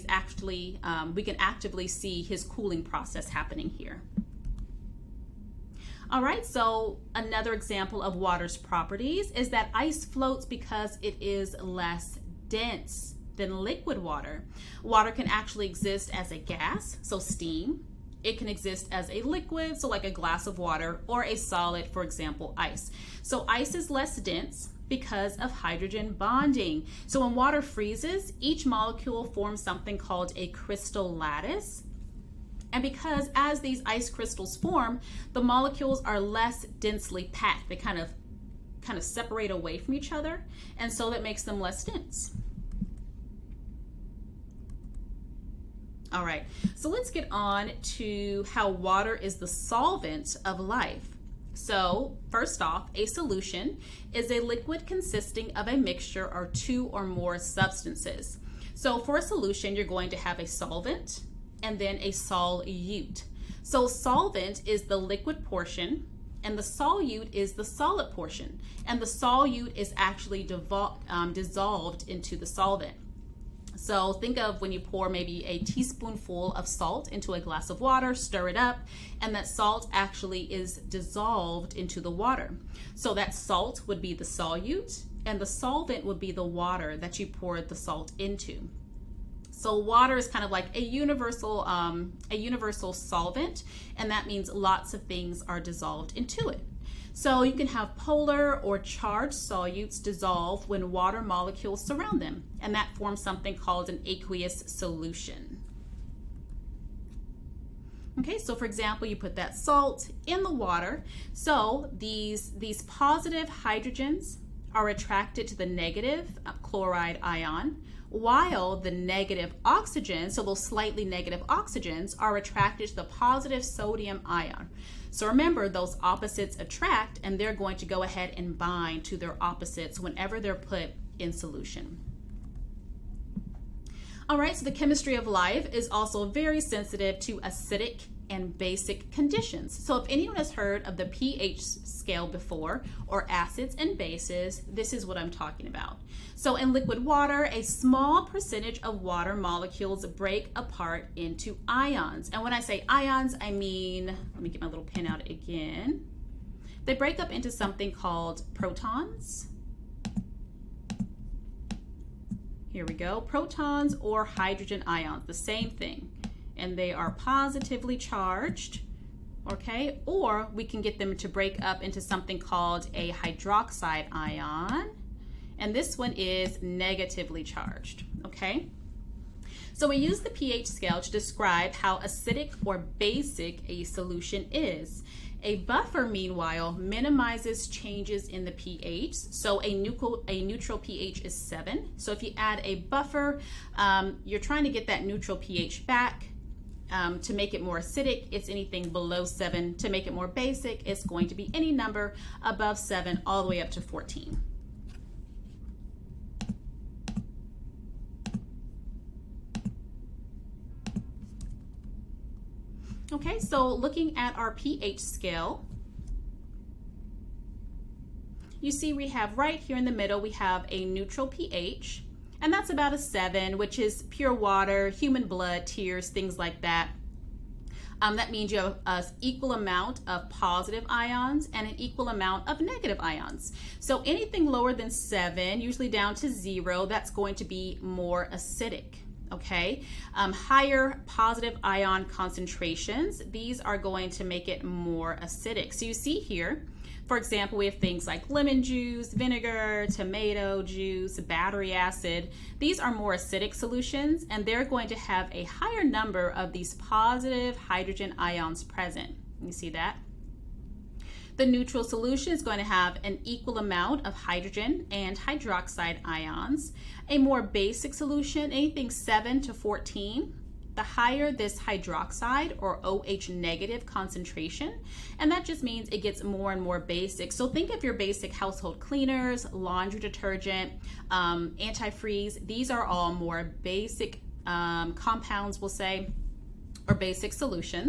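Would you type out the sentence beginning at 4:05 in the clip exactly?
So you see here, for example, we have things like lemon juice, vinegar, tomato juice, battery acid.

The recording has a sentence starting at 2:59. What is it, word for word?
So we use the pH scale to describe how acidic or basic a solution is.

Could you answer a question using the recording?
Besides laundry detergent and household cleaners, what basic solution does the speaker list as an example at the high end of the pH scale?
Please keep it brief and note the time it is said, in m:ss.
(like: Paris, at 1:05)
antifreeze, at 4:41.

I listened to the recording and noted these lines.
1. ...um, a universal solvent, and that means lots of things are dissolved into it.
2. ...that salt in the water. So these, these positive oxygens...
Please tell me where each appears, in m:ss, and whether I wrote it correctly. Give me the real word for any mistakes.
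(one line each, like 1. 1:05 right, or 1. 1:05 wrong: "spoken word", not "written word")
1. 1:31 right
2. 1:49 wrong: "hydrogens", not "oxygens".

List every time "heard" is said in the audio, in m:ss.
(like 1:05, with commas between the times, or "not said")
2:20.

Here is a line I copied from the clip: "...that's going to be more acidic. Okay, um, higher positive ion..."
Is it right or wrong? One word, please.
right.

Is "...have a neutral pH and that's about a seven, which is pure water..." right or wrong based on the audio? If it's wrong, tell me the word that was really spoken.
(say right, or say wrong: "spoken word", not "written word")
right.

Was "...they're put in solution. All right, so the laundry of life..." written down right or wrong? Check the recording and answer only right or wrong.
wrong.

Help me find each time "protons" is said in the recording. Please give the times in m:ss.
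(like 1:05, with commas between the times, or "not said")
2:38, 2:43.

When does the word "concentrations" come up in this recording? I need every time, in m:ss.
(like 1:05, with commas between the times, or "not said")
4:02, 4:33.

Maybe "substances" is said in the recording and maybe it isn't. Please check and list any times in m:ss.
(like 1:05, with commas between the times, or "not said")
0:57.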